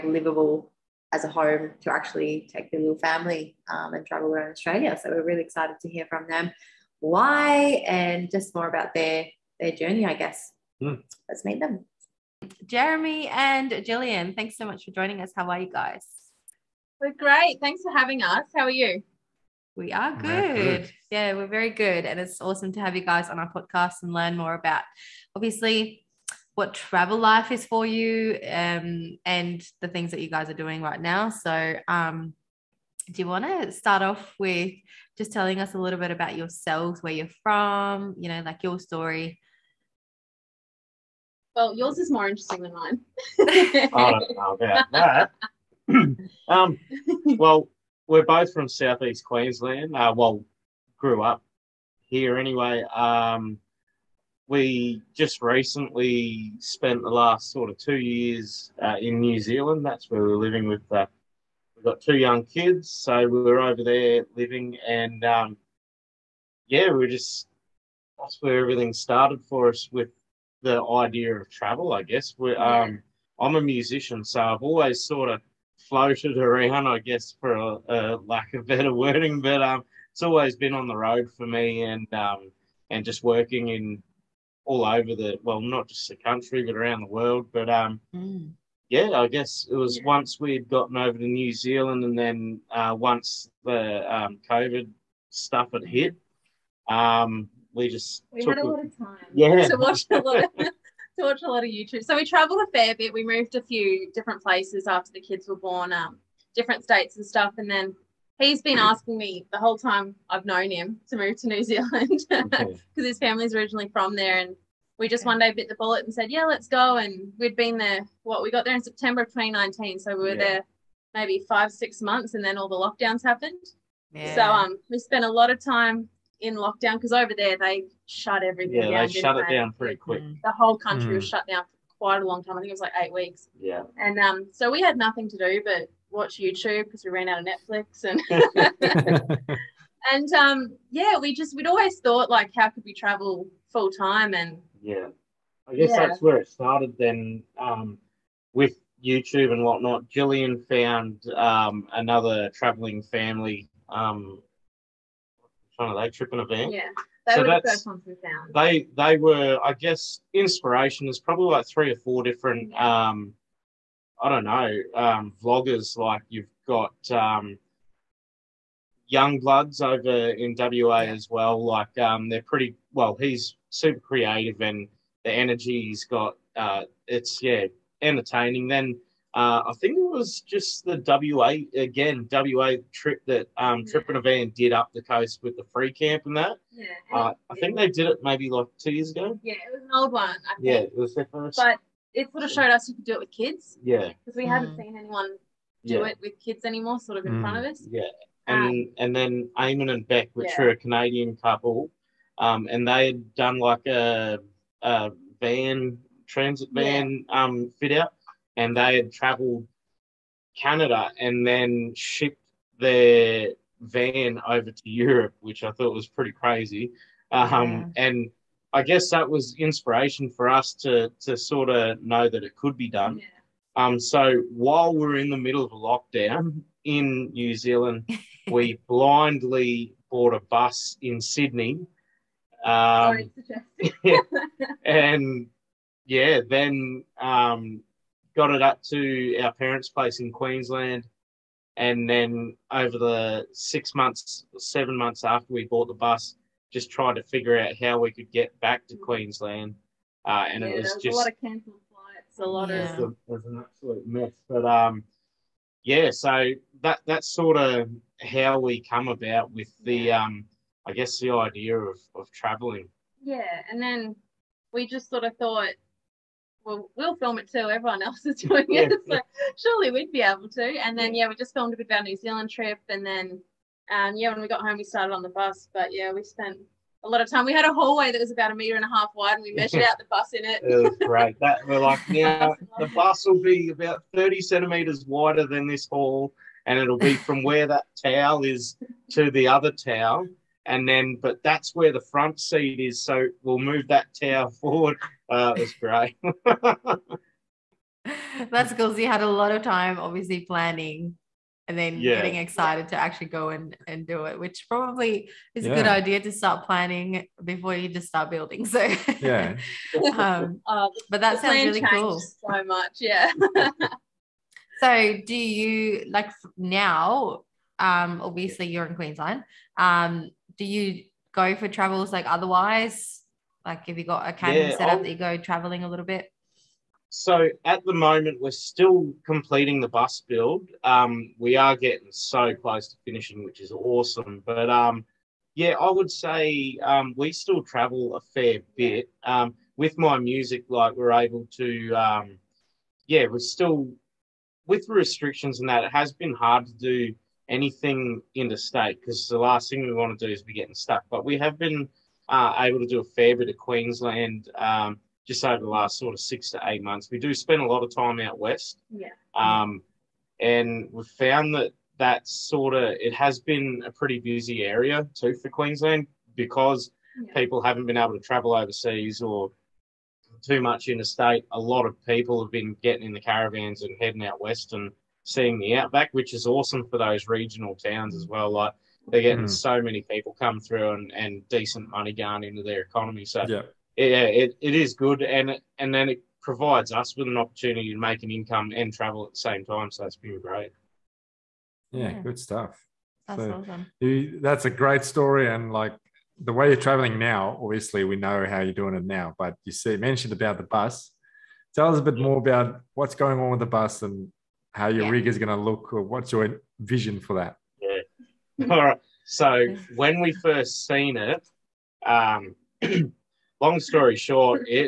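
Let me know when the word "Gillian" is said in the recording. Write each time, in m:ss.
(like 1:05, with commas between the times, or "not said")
0:13, 2:30.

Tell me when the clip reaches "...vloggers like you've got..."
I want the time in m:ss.
2:45.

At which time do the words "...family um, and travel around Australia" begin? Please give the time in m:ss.
0:02.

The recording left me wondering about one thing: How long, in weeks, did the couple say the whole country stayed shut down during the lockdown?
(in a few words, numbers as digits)
8 weeks.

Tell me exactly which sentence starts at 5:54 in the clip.
Um, just over the last sort of six to eight months.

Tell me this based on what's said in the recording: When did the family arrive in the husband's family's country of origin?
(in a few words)
September 2019.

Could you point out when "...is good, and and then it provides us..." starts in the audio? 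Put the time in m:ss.
6:24.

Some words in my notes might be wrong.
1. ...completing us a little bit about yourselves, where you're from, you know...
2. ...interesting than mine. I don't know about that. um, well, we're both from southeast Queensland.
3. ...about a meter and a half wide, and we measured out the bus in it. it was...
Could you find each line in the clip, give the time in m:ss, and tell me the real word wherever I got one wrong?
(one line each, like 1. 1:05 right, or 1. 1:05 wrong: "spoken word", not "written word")
1. 0:35 wrong: "telling", not "completing"
2. 0:42 right
3. 4:38 right.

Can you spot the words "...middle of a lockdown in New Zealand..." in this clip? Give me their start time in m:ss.
3:45.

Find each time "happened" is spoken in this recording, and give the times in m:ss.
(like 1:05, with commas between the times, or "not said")
2:03.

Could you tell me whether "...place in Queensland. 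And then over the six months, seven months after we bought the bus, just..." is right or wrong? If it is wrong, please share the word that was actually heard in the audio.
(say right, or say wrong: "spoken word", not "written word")
right.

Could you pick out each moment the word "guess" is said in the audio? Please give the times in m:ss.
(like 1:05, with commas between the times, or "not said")
0:10, 1:12, 1:16, 1:29, 2:25, 2:39, 3:38, 4:20.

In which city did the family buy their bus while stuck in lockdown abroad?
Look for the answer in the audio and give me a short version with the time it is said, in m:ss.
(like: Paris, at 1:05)
Sydney, at 3:51.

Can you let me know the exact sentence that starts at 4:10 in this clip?
Uh, and yeah, it was just a lot of cancelled flights, a lot yeah.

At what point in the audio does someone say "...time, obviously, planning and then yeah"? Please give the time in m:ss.
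4:59.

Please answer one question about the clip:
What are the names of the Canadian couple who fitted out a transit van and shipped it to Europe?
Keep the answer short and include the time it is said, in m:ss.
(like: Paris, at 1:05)
Eamon and Bec, at 3:19.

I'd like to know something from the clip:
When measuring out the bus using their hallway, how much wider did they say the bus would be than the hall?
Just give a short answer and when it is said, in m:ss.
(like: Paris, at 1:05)
30 centimeters, at 4:44.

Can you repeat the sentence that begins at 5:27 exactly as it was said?
So at the moment, we're still completing the bus build.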